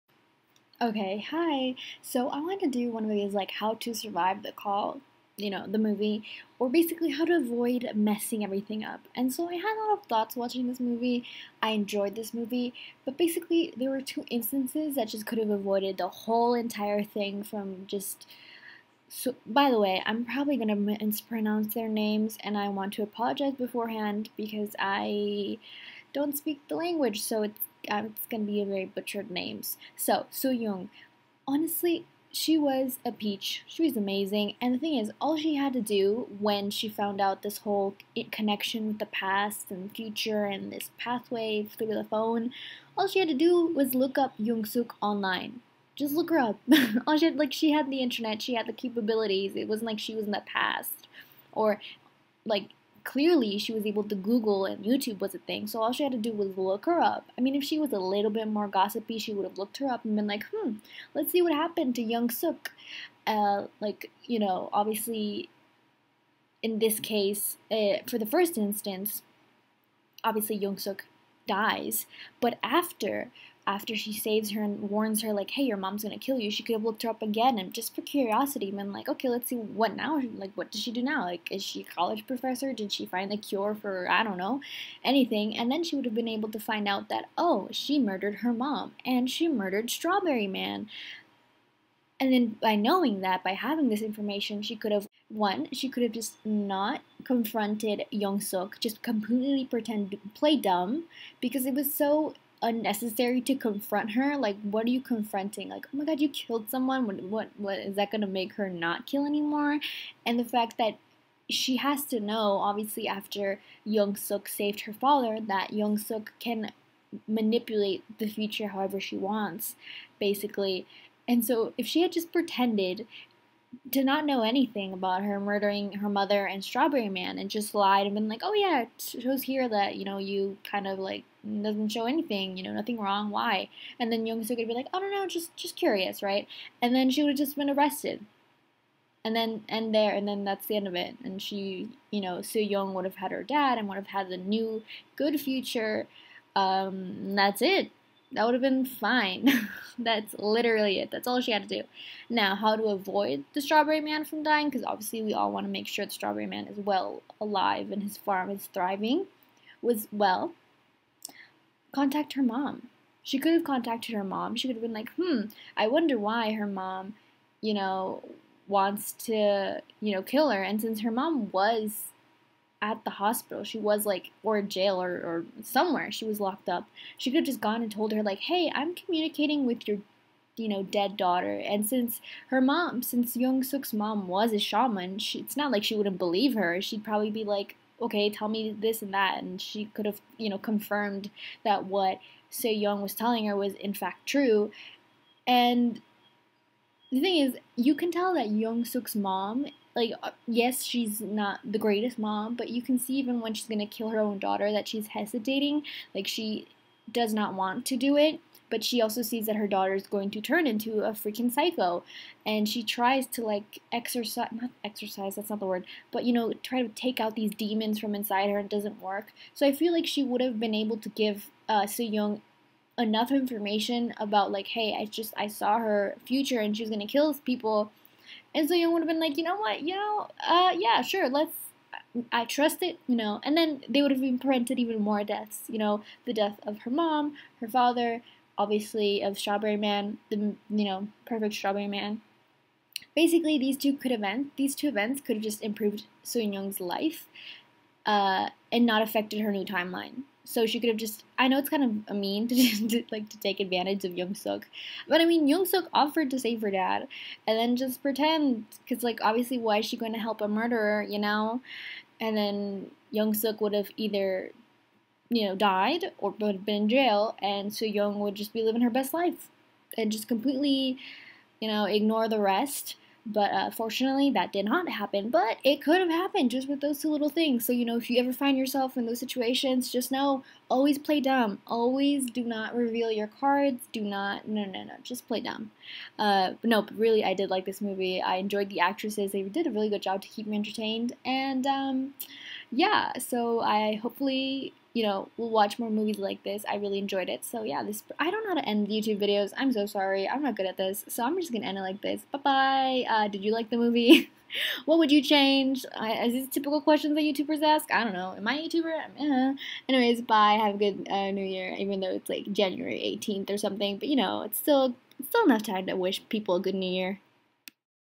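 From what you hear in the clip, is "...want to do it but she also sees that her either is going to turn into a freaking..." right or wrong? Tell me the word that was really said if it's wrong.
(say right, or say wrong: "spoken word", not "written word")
wrong: "daughter", not "either".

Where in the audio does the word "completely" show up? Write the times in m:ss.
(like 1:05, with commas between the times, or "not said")
1:39, 4:30.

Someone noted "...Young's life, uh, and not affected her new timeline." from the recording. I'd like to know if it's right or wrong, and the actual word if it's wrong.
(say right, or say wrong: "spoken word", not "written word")
right.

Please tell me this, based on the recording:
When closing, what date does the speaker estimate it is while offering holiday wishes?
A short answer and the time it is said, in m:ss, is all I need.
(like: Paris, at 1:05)
January 18th, at 5:12.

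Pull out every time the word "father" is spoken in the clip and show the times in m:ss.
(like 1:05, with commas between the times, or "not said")
1:54, 3:57.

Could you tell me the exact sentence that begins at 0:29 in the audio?
So Soo Young, honestly, she was a peach.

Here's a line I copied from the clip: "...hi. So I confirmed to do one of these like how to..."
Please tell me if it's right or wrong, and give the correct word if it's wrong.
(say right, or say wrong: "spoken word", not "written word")
wrong: "wanted", not "confirmed".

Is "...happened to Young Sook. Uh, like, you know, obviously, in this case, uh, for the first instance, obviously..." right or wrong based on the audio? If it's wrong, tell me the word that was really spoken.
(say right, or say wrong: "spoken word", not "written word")
right.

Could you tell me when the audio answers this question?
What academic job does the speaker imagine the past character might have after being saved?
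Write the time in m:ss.
1:21.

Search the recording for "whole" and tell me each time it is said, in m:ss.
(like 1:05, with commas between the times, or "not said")
0:16, 0:37.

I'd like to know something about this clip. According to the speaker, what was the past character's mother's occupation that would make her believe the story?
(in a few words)
Shaman.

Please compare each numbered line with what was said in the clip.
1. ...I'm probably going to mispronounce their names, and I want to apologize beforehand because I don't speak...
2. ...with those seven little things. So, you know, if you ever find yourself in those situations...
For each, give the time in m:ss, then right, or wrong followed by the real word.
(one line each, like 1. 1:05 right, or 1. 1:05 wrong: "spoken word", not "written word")
1. 0:20 right
2. 4:36 wrong: "two", not "seven".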